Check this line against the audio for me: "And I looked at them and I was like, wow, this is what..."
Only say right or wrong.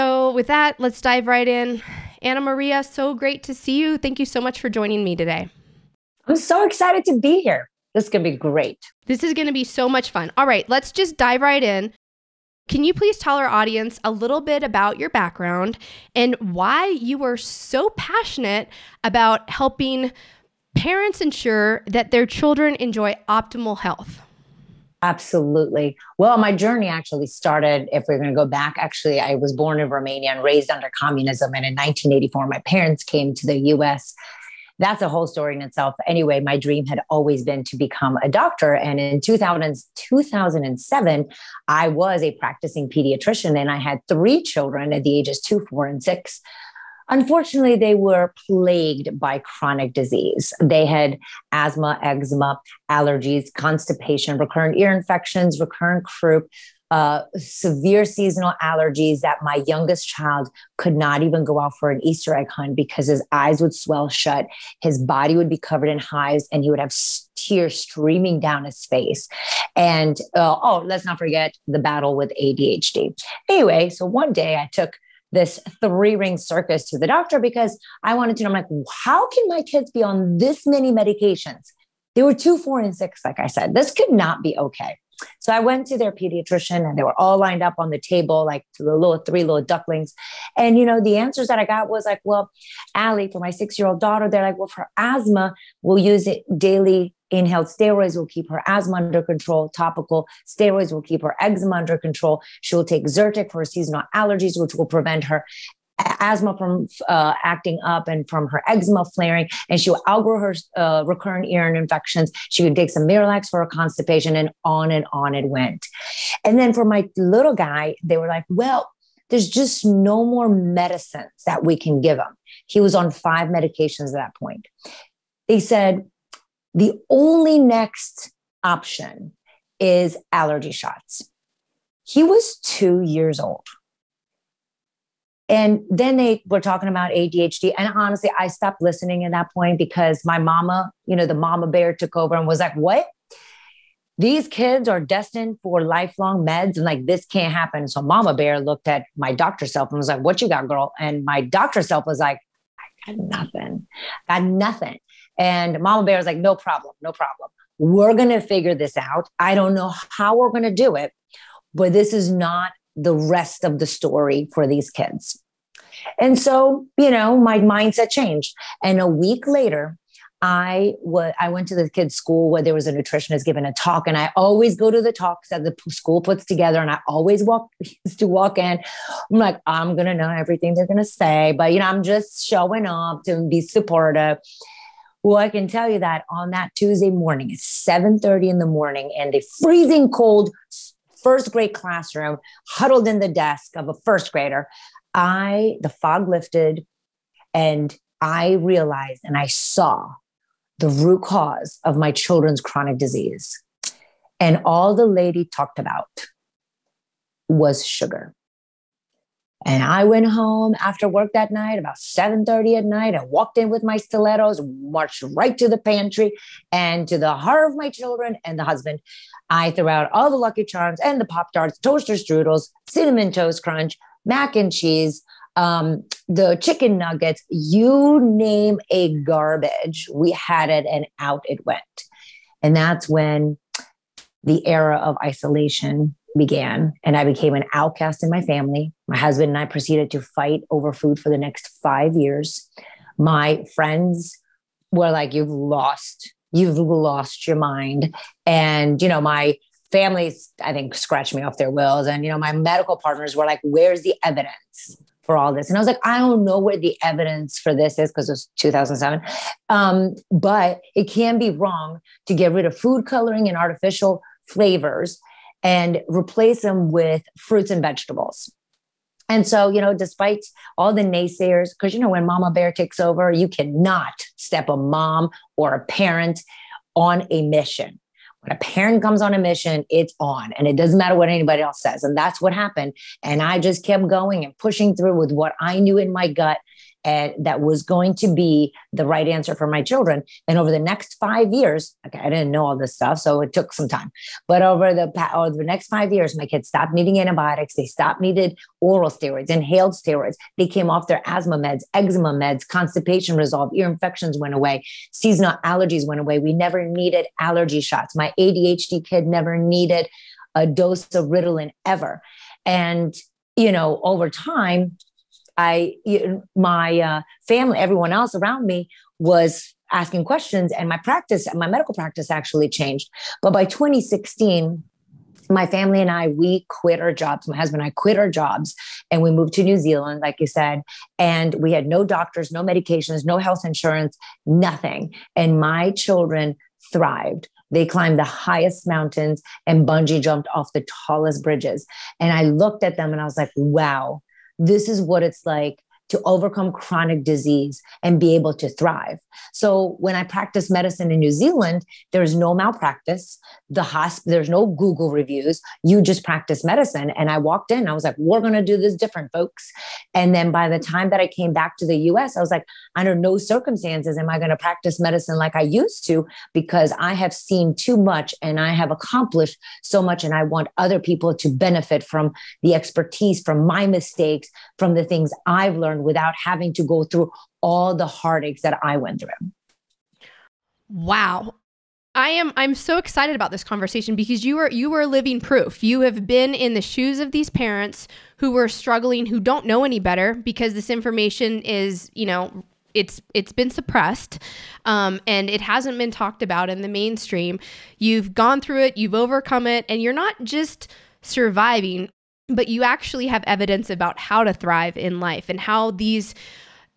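right.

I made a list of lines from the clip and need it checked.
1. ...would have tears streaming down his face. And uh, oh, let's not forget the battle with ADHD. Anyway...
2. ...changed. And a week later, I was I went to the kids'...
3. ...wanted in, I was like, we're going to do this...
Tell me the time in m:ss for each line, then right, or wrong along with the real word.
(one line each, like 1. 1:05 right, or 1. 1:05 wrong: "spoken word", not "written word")
1. 1:06 right
2. 2:48 right
3. 5:57 wrong: "walked", not "wanted".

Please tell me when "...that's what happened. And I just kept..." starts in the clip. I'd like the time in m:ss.
4:42.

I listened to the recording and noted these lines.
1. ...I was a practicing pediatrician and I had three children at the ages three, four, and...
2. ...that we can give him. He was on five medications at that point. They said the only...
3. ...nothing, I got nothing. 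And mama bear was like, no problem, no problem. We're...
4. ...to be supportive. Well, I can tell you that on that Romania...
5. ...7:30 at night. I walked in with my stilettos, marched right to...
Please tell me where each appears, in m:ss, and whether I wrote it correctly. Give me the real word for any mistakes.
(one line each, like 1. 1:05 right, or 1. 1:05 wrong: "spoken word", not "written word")
1. 0:41 wrong: "two", not "three"
2. 2:01 right
3. 2:33 right
4. 3:03 wrong: "Tuesday", not "Romania"
5. 3:31 right.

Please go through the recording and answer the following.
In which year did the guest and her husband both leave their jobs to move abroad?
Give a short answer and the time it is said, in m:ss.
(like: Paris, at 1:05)
2016, at 5:23.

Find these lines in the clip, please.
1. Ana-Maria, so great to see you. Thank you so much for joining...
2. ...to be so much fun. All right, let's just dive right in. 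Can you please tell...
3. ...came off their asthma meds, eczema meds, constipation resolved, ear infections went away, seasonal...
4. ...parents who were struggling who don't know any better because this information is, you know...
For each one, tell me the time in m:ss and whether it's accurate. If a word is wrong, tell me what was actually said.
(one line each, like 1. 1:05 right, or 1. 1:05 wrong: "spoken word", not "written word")
1. 0:02 right
2. 0:09 right
3. 5:00 right
4. 6:27 right.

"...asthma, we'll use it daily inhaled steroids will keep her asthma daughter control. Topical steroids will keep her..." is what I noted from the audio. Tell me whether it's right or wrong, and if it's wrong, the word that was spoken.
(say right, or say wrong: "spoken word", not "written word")
wrong: "under", not "daughter".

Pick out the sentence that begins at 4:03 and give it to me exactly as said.
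My friends were like, You've lost, you've lost your mind.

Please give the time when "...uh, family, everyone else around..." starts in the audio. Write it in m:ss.
5:16.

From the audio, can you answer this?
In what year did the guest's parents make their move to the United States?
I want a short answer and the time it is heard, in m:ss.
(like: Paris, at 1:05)
1984, at 0:31.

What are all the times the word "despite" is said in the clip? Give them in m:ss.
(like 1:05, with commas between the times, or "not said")
4:29.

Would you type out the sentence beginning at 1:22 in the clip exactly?
They were two, four, and six, like I said.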